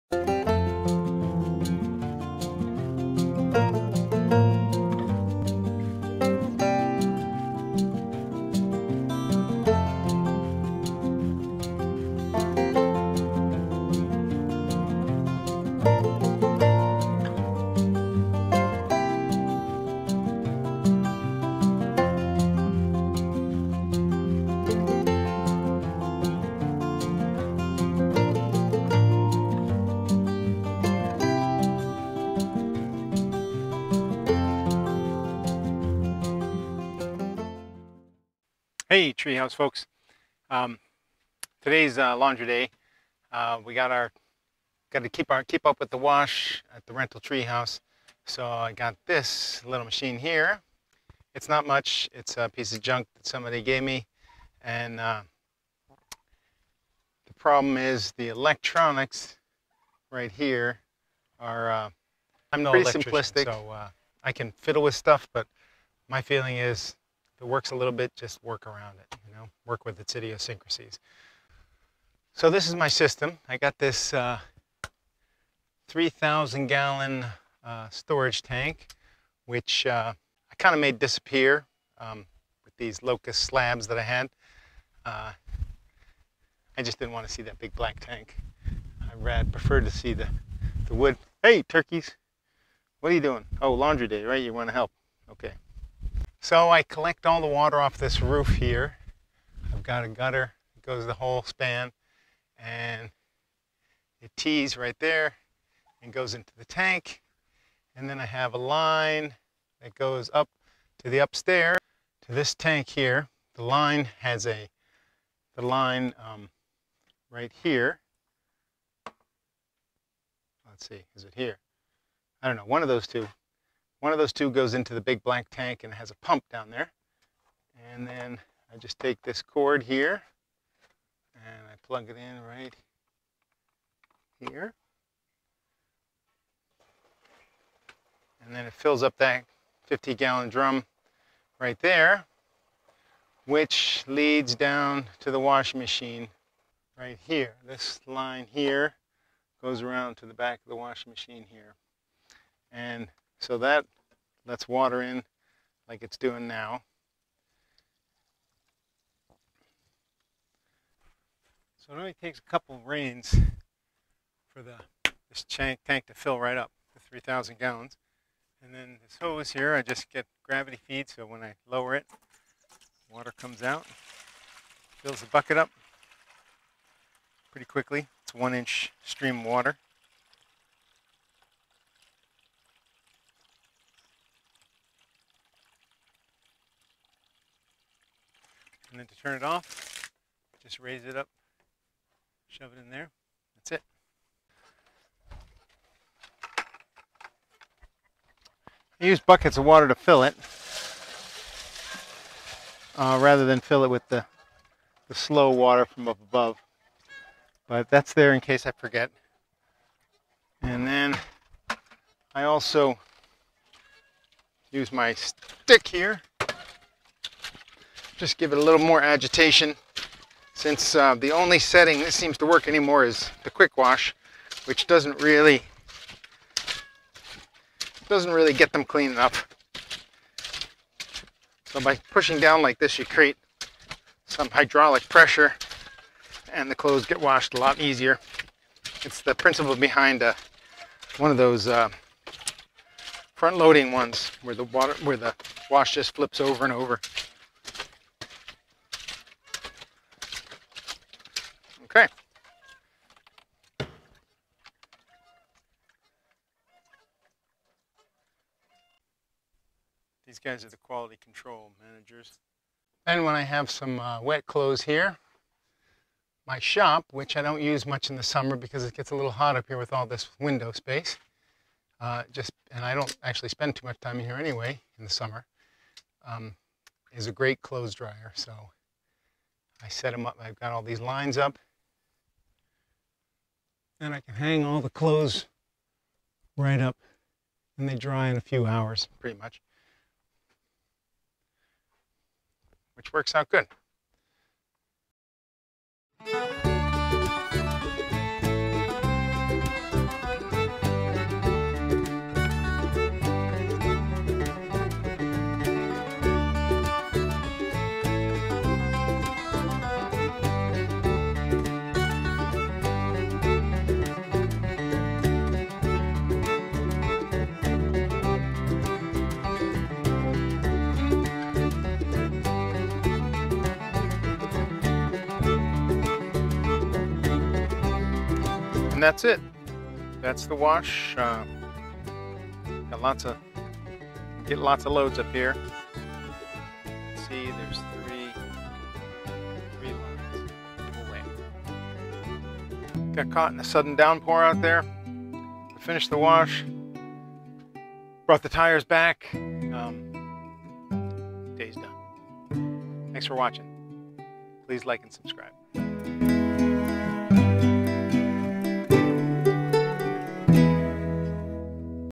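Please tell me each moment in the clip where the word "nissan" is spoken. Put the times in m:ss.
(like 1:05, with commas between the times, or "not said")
not said.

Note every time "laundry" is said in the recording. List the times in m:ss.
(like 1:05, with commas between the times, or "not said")
0:42, 1:33.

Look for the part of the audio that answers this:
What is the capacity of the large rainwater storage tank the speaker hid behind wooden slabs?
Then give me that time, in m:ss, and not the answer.
1:15.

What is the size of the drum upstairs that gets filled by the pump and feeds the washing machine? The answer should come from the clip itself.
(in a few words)
50 gallon.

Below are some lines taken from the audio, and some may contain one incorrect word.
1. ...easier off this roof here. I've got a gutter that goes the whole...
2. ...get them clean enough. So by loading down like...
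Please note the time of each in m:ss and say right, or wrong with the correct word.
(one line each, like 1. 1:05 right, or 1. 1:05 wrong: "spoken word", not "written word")
1. 1:37 wrong: "water", not "easier"
2. 3:48 wrong: "pushing", not "loading".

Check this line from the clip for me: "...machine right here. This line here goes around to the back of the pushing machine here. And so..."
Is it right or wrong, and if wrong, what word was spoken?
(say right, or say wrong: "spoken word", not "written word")
wrong: "washing", not "pushing".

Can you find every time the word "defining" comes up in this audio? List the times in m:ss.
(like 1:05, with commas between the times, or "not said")
not said.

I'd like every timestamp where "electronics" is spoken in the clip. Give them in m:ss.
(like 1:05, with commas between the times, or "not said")
0:58.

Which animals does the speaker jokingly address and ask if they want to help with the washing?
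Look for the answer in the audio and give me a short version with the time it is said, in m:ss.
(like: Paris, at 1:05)
Turkeys, at 1:31.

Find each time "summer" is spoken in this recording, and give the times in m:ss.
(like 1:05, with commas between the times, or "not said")
4:28, 4:35.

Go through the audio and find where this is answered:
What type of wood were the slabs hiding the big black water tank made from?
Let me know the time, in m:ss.
1:23.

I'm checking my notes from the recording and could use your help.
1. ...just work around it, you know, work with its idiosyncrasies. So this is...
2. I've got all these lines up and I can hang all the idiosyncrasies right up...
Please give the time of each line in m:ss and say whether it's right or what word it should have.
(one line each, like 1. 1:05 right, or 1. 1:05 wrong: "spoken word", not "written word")
1. 1:08 right
2. 4:40 wrong: "clothes", not "idiosyncrasies".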